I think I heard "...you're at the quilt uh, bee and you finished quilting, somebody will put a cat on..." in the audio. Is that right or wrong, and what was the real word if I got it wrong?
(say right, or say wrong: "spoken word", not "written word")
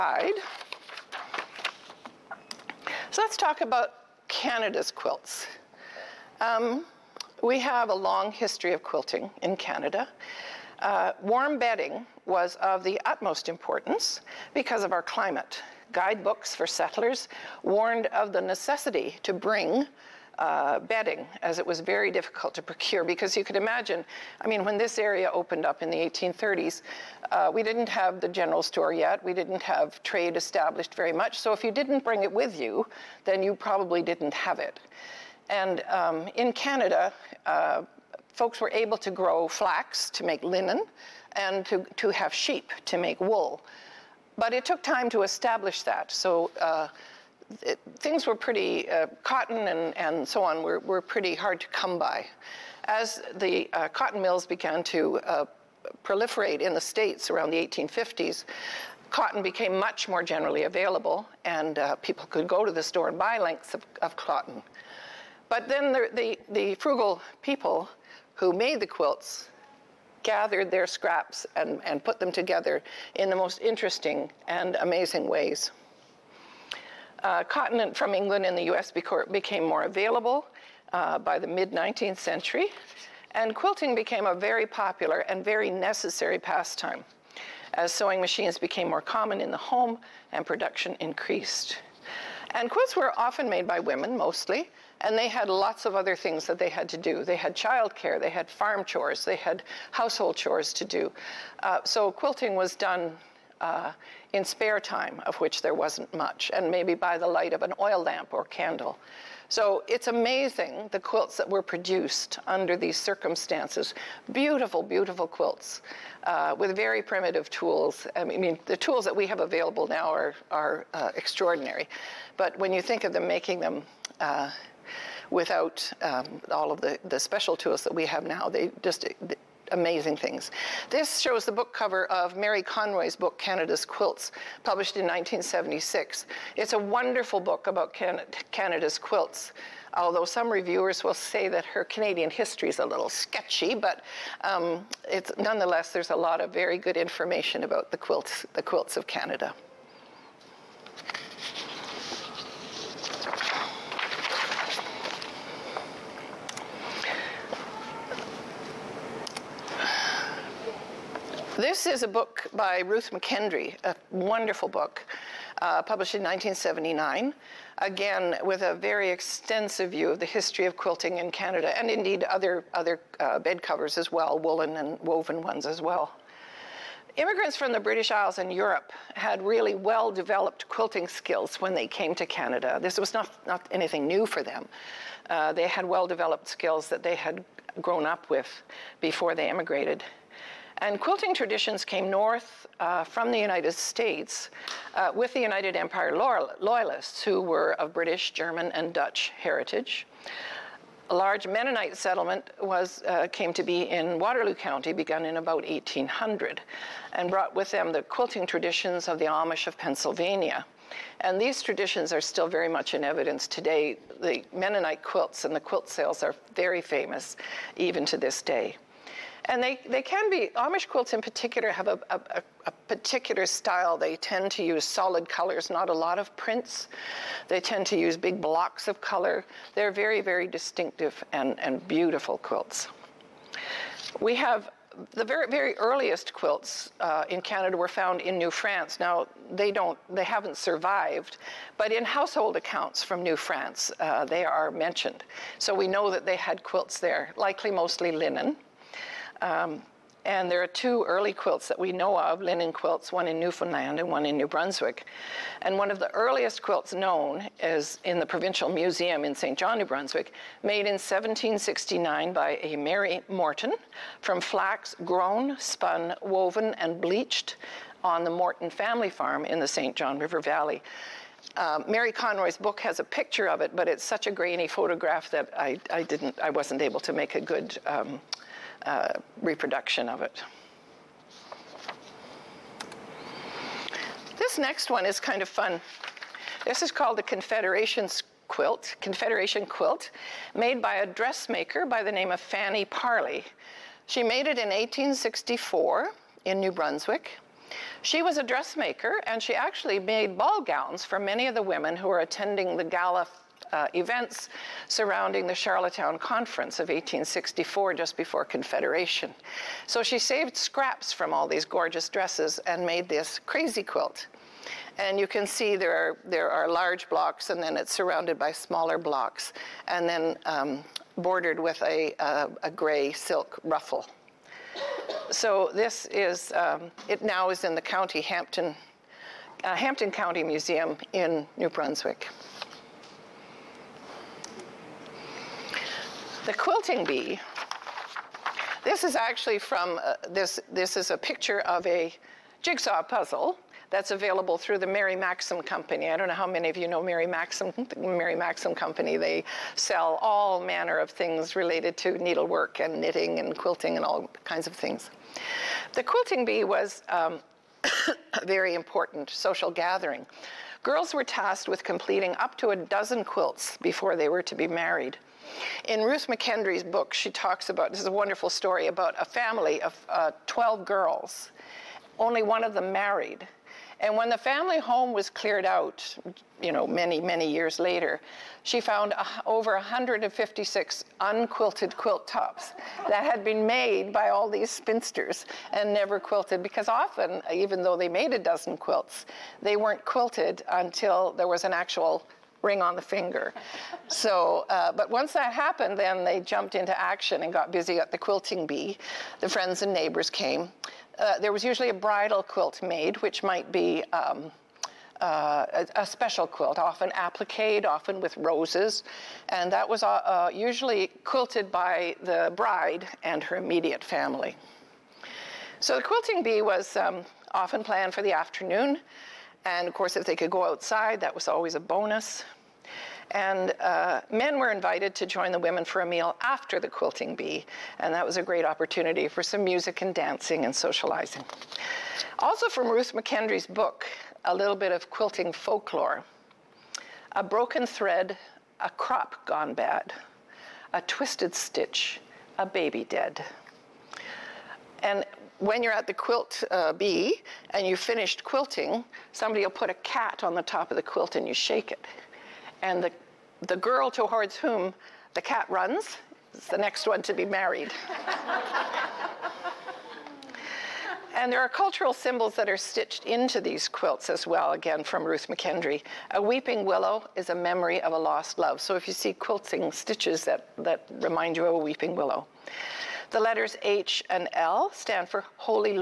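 right.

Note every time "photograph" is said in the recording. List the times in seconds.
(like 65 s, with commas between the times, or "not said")
274 s.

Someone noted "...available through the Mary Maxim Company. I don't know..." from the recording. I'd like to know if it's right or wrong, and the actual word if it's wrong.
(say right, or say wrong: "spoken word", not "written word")
right.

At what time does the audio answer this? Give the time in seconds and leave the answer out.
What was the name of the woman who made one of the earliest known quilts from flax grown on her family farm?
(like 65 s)
262 s.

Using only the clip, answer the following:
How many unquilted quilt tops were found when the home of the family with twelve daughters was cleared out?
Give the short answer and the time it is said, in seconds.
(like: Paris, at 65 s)
Over 156, at 379 s.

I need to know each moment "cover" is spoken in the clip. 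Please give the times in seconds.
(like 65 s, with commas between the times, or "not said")
131 s, 173 s.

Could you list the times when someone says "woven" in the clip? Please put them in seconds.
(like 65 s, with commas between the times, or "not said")
175 s, 266 s.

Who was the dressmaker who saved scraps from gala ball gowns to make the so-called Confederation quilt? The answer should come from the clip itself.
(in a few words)
Fanny Parlee.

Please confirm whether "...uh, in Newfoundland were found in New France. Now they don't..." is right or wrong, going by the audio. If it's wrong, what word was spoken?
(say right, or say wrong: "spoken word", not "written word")
wrong: "Canada", not "Newfoundland".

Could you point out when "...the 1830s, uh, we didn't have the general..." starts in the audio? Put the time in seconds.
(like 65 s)
25 s.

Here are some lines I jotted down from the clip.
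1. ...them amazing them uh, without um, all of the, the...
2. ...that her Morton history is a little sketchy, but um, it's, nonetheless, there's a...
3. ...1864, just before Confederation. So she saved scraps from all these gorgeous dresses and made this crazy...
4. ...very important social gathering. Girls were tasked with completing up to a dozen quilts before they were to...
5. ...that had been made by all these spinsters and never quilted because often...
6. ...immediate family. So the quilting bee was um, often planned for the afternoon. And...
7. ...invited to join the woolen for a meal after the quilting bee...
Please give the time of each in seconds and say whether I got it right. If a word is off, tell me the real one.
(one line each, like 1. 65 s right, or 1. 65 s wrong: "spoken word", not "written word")
1. 123 s wrong: "making", not "amazing"
2. 141 s wrong: "Canadian", not "Morton"
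3. 306 s right
4. 358 s right
5. 383 s right
6. 413 s right
7. 424 s wrong: "women", not "woolen".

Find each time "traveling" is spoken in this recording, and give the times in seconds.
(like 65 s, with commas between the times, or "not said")
not said.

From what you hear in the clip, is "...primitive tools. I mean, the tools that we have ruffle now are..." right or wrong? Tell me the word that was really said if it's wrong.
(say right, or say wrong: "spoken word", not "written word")
wrong: "available", not "ruffle".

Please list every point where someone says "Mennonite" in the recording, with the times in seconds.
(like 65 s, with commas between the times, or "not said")
201 s, 214 s.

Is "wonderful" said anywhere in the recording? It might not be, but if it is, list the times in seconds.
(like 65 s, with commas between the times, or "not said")
136 s, 164 s, 368 s.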